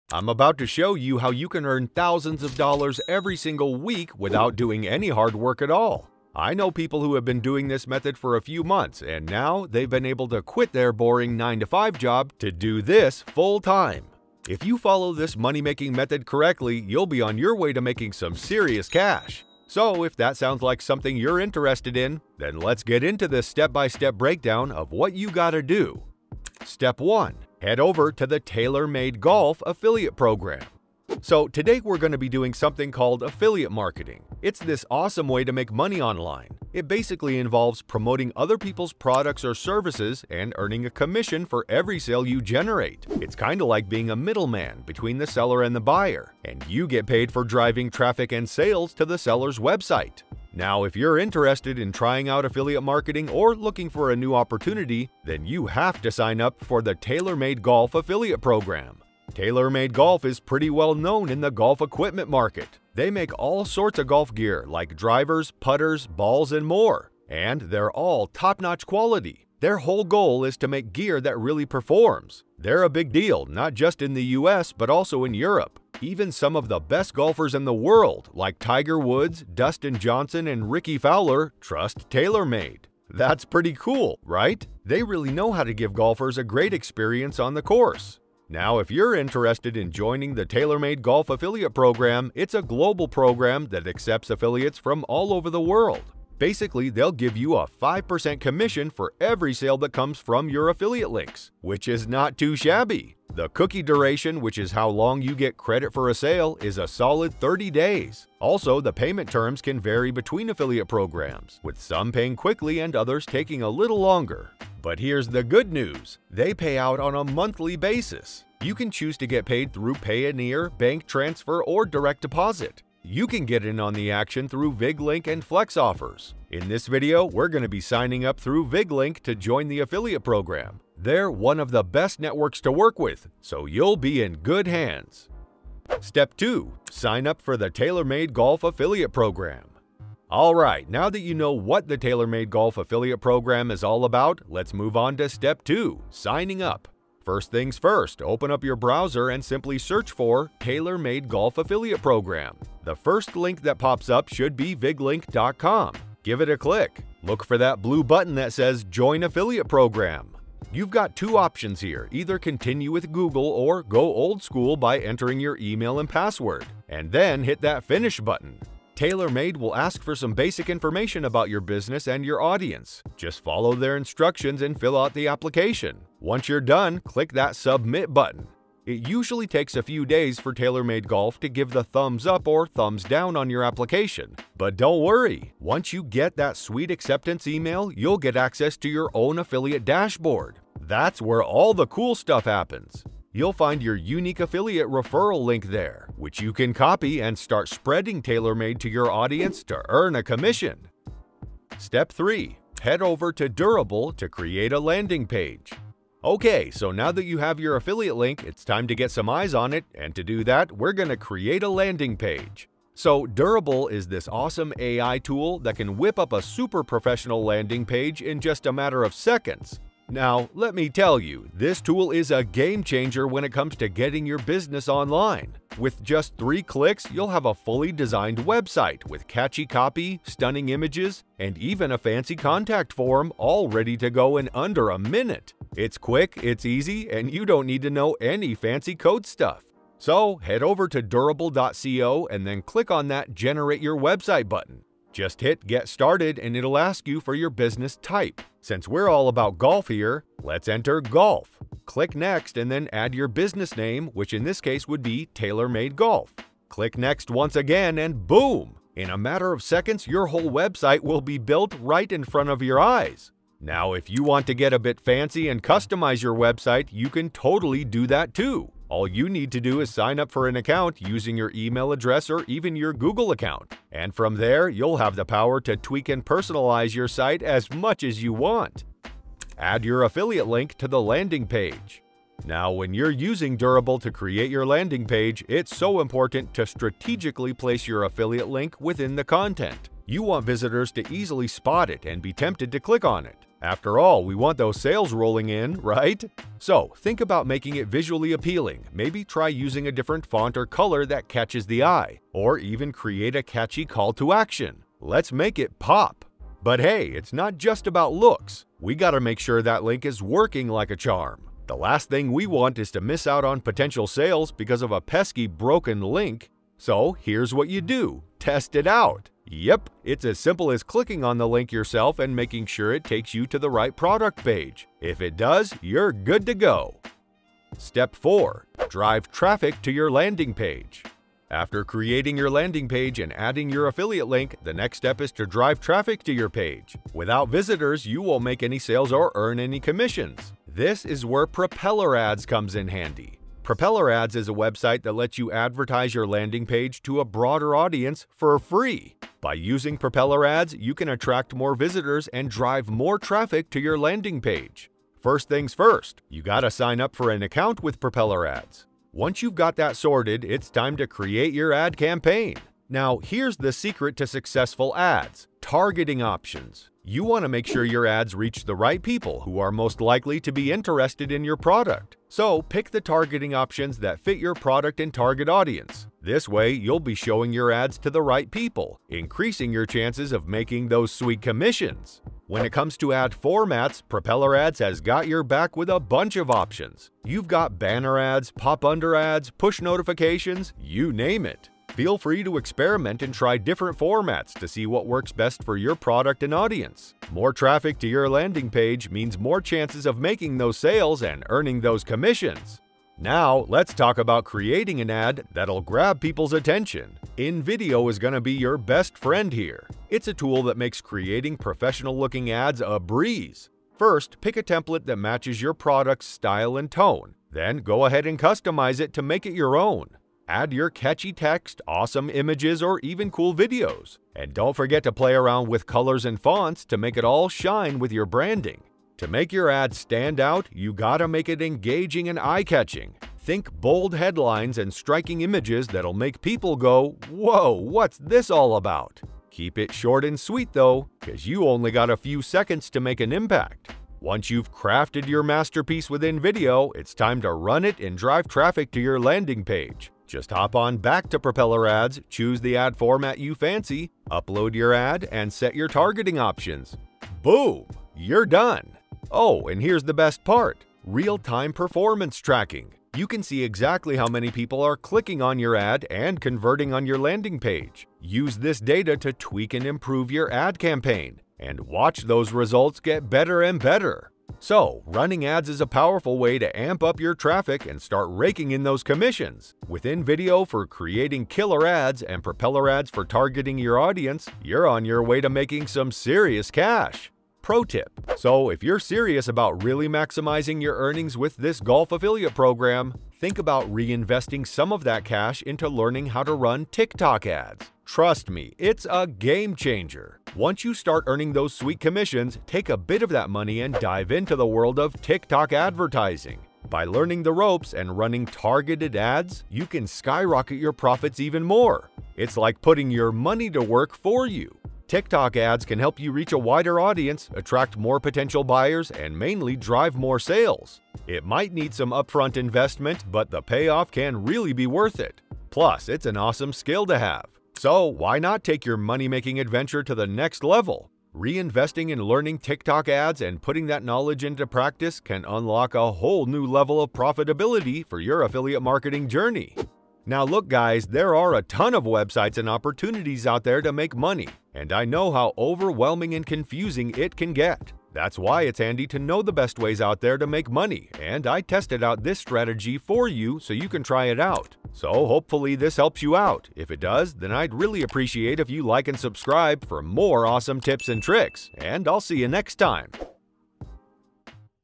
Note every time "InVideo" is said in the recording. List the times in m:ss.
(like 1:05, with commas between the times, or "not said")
6:47, 7:26, 8:00.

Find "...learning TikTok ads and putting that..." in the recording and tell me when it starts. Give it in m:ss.
8:52.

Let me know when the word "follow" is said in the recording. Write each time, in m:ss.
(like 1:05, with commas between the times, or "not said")
0:14, 2:53.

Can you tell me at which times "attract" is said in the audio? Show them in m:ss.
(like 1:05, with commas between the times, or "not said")
5:51, 8:37.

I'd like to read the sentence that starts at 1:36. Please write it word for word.
Basically, they'll give you a 5% commission for every sale that comes from your affiliate links, which is not too shabby.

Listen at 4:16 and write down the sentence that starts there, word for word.
Click Next once again and boom!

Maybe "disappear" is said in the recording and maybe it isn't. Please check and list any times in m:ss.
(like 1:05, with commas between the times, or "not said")
not said.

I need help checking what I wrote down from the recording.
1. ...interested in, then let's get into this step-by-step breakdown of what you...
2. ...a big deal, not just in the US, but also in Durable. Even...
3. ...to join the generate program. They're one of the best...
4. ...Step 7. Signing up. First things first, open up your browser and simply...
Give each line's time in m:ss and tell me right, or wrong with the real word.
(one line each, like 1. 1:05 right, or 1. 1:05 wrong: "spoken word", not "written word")
1. 0:21 right
2. 1:12 wrong: "Europe", not "Durable"
3. 2:09 wrong: "affiliate", not "generate"
4. 2:25 wrong: "2", not "7".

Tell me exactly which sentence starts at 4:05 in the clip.
Just hit Get Started and it'll ask you for your business type.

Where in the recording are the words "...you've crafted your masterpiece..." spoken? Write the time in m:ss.
7:24.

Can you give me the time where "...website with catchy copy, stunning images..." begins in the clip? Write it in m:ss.
3:48.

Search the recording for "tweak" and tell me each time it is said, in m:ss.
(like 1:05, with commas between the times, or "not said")
4:35, 7:49.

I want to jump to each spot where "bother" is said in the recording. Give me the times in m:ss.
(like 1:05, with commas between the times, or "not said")
not said.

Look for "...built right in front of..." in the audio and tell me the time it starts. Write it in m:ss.
4:21.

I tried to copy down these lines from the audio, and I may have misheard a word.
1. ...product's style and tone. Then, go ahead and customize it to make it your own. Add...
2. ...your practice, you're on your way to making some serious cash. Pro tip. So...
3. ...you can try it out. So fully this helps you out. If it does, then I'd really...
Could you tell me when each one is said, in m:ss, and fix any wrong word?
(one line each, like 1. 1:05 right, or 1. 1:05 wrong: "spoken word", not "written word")
1. 6:55 right
2. 8:03 wrong: "audience", not "practice"
3. 9:13 wrong: "hopefully", not "fully".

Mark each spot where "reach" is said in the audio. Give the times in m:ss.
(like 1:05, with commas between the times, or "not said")
6:08, 8:36.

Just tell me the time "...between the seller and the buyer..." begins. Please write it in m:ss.
0:44.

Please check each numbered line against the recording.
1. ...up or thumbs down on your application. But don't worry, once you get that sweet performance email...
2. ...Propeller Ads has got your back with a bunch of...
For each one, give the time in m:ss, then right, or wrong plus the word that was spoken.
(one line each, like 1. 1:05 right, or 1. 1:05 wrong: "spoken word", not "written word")
1. 3:02 wrong: "acceptance", not "performance"
2. 6:24 right.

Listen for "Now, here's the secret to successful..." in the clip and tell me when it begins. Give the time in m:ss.
6:02.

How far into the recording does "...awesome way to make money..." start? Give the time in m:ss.
0:34.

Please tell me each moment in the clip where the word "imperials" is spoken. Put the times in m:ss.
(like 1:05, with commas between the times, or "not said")
not said.